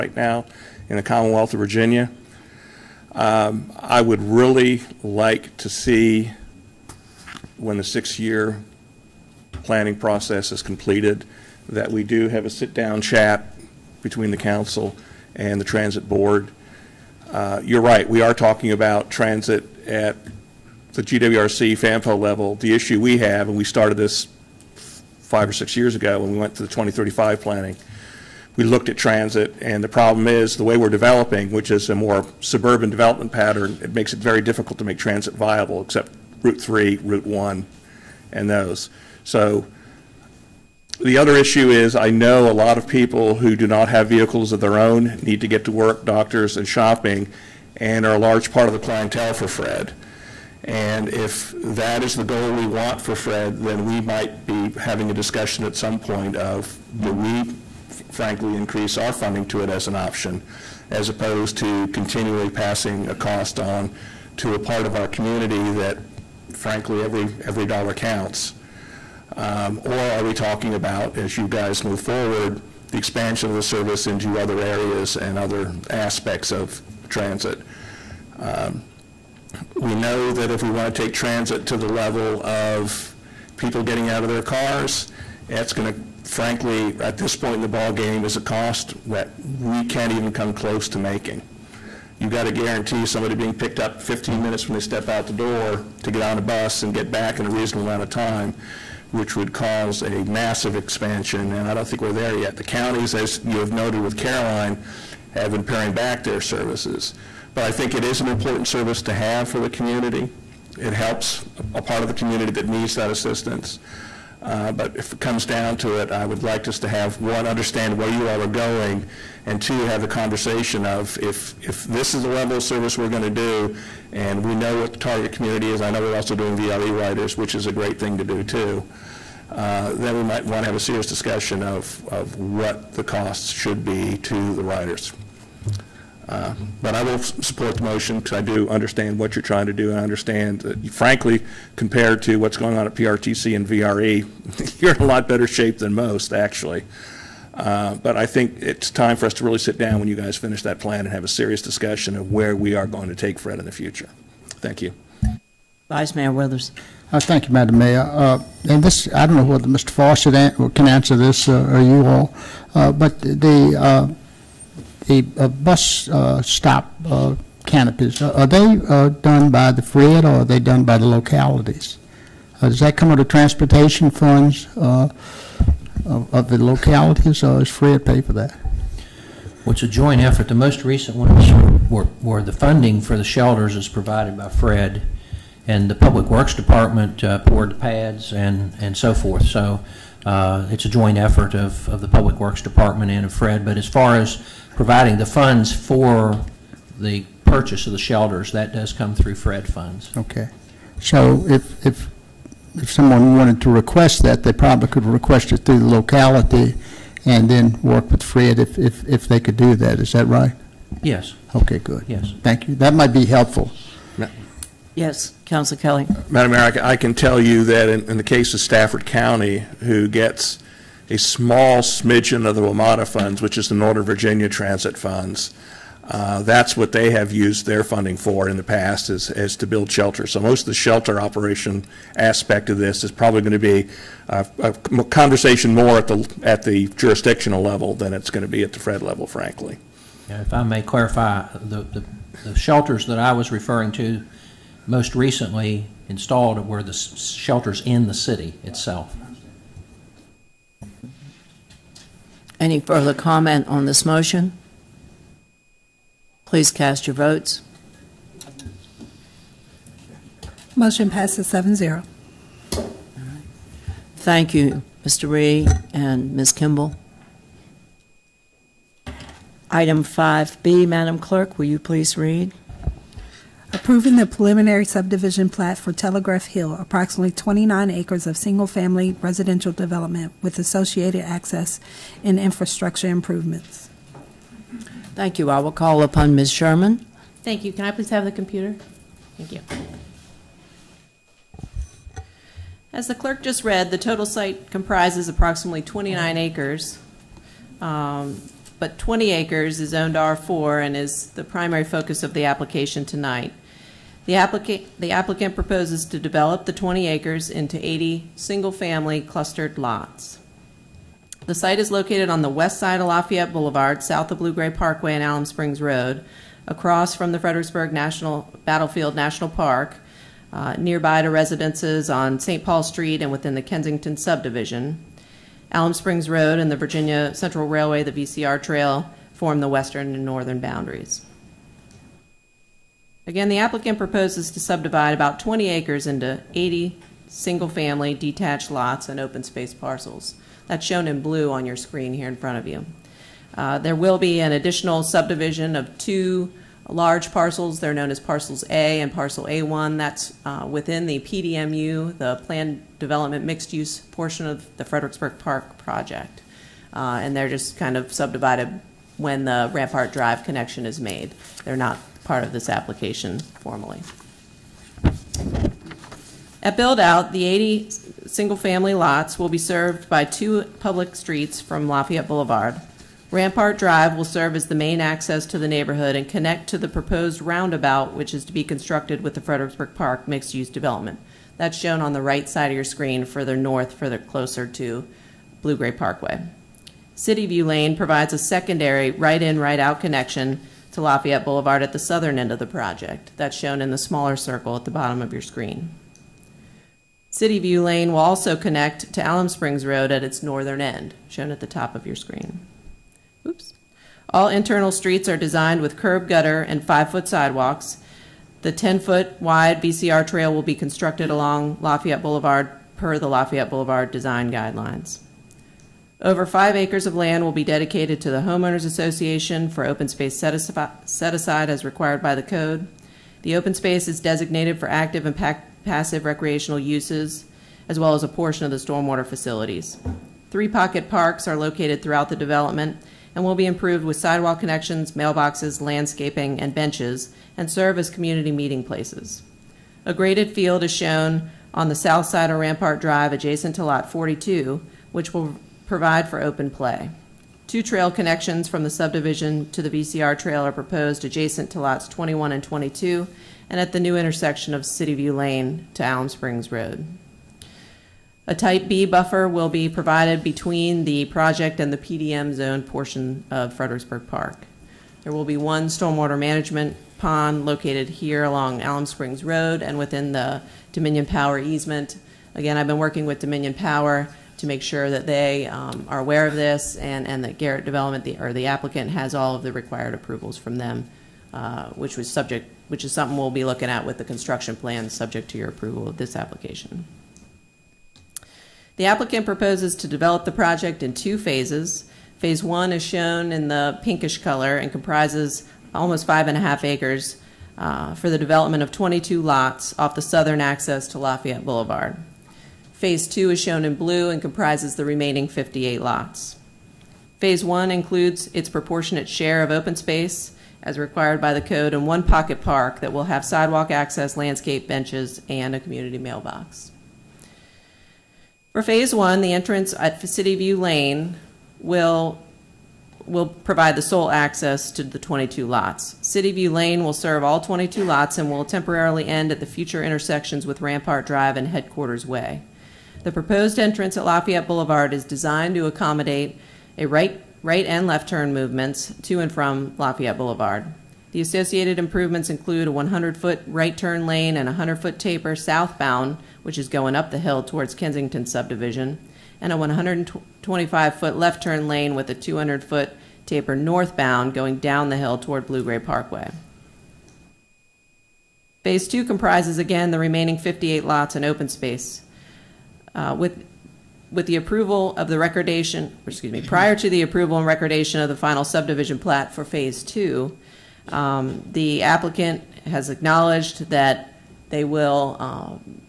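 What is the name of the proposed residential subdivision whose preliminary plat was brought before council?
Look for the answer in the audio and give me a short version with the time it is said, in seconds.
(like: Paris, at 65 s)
Telegraph Hill, at 275 s.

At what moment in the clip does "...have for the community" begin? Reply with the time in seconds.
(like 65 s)
109 s.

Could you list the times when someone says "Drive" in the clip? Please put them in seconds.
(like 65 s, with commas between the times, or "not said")
360 s, 373 s, 442 s, 531 s.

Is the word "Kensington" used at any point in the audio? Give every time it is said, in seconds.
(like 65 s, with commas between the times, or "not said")
323 s, 547 s.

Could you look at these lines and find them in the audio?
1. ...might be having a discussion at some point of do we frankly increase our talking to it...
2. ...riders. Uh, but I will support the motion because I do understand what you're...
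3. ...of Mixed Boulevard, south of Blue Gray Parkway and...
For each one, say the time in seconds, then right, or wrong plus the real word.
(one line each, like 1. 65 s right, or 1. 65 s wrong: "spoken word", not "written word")
1. 53 s wrong: "funding", not "talking"
2. 134 s right
3. 312 s wrong: "Lafayette", not "Mixed".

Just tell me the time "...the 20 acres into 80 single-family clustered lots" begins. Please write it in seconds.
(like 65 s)
306 s.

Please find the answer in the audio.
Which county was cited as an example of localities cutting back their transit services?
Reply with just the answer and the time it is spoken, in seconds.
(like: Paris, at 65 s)
Caroline, at 104 s.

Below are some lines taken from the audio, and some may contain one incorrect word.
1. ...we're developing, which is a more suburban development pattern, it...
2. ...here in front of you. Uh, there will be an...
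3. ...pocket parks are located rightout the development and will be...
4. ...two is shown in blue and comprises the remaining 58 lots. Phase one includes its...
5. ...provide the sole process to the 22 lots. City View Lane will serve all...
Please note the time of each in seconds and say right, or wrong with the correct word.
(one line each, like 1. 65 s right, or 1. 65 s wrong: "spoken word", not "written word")
1. 30 s right
2. 342 s right
3. 430 s wrong: "throughout", not "rightout"
4. 503 s right
5. 523 s wrong: "access", not "process".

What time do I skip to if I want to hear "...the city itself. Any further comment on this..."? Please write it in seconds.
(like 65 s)
248 s.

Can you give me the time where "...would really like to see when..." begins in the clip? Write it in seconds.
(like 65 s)
4 s.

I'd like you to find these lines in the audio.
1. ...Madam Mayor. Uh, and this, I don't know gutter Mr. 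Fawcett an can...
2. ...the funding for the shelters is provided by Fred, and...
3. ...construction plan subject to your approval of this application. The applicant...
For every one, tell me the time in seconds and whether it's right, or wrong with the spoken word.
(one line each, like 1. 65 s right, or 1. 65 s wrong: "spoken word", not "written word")
1. 157 s wrong: "whether", not "gutter"
2. 182 s right
3. 484 s right.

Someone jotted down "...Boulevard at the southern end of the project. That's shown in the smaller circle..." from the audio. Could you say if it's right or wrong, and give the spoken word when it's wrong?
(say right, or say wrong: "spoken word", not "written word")
right.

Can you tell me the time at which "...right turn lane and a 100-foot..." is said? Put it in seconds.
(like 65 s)
543 s.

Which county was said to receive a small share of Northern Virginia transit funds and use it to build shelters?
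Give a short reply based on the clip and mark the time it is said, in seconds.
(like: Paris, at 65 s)
Stafford County, at 218 s.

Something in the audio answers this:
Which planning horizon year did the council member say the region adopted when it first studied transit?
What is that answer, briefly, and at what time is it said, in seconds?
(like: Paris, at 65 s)
2035, at 26 s.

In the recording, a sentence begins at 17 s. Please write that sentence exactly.
Uh, you're right, we are talking about transit at the GWRC FAMPO level.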